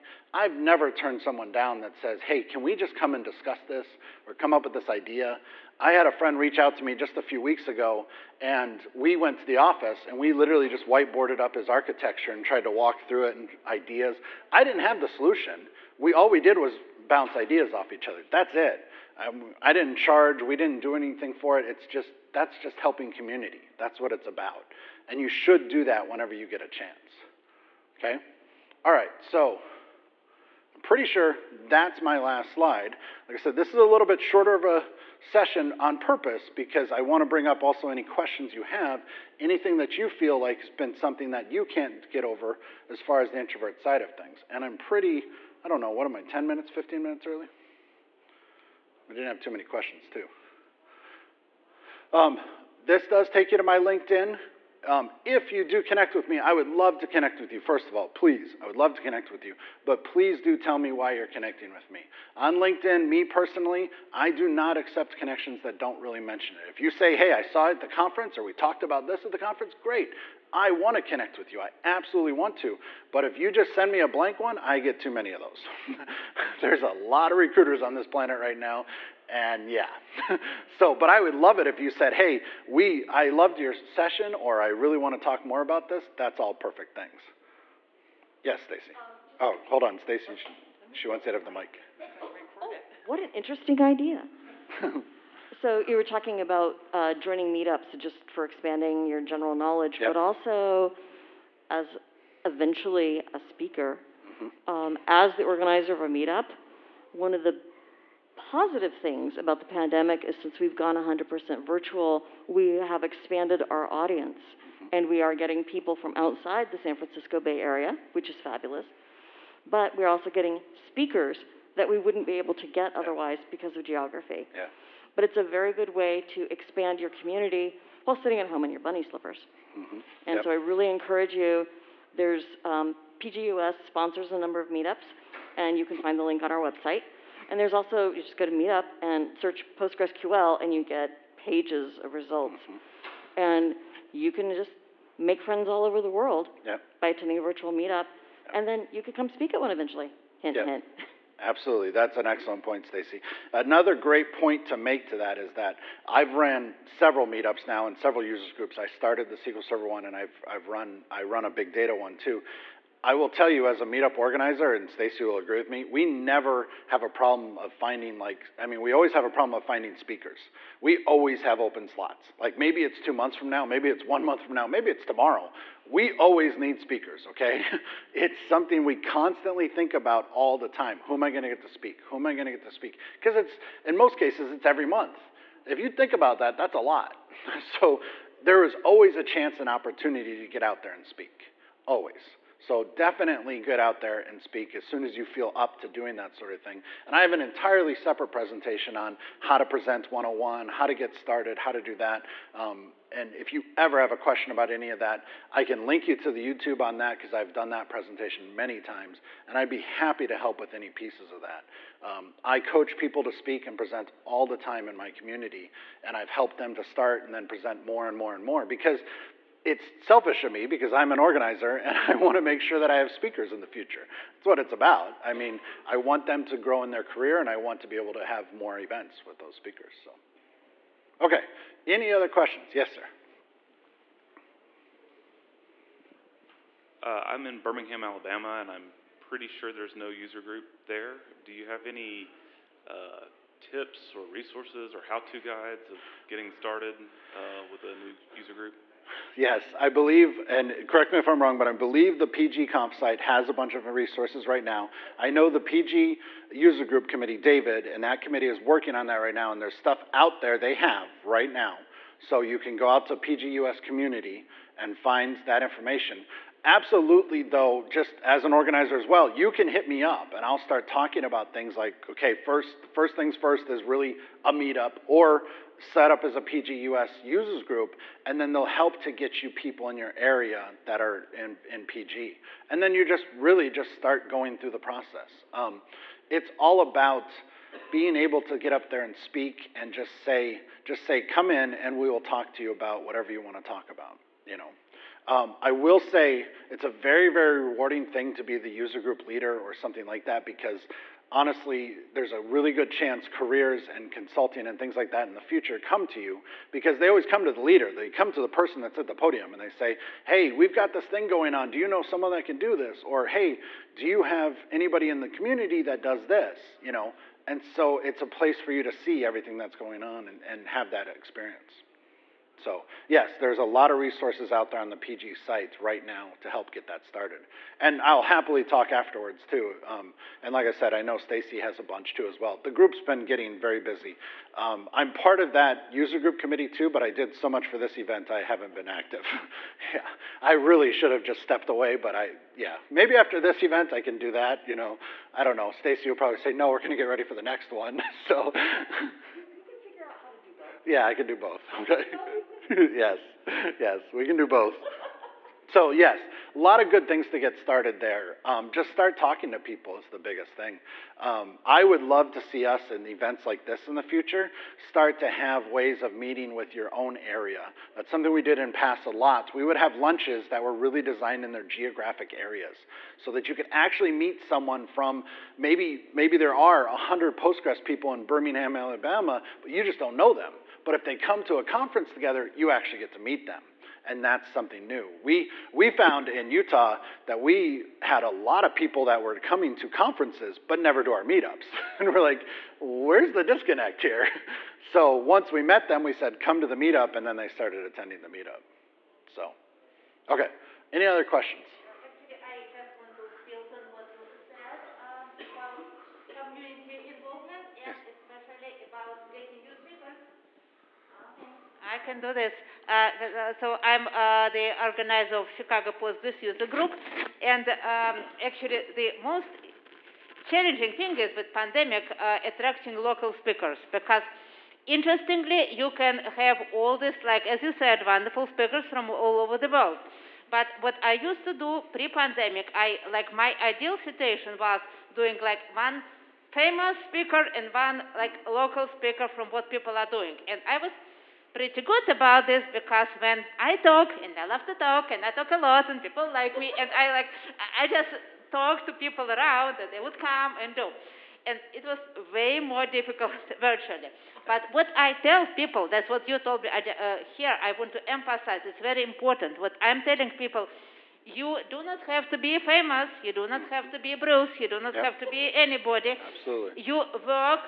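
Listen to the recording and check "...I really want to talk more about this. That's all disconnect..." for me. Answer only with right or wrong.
wrong.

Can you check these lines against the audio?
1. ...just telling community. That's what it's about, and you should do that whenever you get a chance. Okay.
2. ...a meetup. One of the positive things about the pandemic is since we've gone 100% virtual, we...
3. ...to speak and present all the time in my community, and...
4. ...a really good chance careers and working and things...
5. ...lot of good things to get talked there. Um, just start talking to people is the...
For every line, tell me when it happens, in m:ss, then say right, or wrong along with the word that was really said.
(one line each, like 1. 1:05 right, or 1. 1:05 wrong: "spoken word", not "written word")
1. 0:22 wrong: "helping", not "telling"
2. 1:46 right
3. 3:33 right
4. 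5:02 wrong: "consulting", not "working"
5. 5:56 wrong: "started", not "talked".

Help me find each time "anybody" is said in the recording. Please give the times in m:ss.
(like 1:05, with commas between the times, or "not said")
5:14, 7:45.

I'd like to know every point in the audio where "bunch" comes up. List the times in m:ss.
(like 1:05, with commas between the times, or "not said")
4:13, 5:31.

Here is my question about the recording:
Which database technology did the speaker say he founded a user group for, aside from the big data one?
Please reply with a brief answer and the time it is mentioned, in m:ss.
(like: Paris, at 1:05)
SQL Server, at 2:39.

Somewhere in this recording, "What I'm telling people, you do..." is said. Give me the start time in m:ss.
7:39.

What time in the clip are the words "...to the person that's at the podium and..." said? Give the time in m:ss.
5:08.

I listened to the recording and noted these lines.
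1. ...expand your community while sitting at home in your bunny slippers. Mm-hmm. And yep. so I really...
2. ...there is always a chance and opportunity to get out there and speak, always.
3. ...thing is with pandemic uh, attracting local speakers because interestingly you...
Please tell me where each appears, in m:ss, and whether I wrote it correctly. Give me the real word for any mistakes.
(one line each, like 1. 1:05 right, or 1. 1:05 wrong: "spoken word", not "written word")
1. 2:06 right
2. 3:08 right
3. 7:00 right.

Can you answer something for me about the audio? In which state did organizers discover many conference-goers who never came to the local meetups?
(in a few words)
Utah.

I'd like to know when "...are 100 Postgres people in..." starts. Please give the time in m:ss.
6:16.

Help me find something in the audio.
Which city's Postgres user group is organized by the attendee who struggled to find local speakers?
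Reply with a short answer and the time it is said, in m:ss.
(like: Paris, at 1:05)
Chicago, at 6:55.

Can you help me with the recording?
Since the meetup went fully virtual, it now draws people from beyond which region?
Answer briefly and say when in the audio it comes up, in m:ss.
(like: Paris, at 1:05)
San Francisco Bay Area, at 1:56.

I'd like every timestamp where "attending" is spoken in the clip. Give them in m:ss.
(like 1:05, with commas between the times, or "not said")
2:27, 6:37.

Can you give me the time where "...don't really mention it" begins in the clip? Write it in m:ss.
1:05.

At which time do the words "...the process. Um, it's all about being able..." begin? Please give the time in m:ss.
4:44.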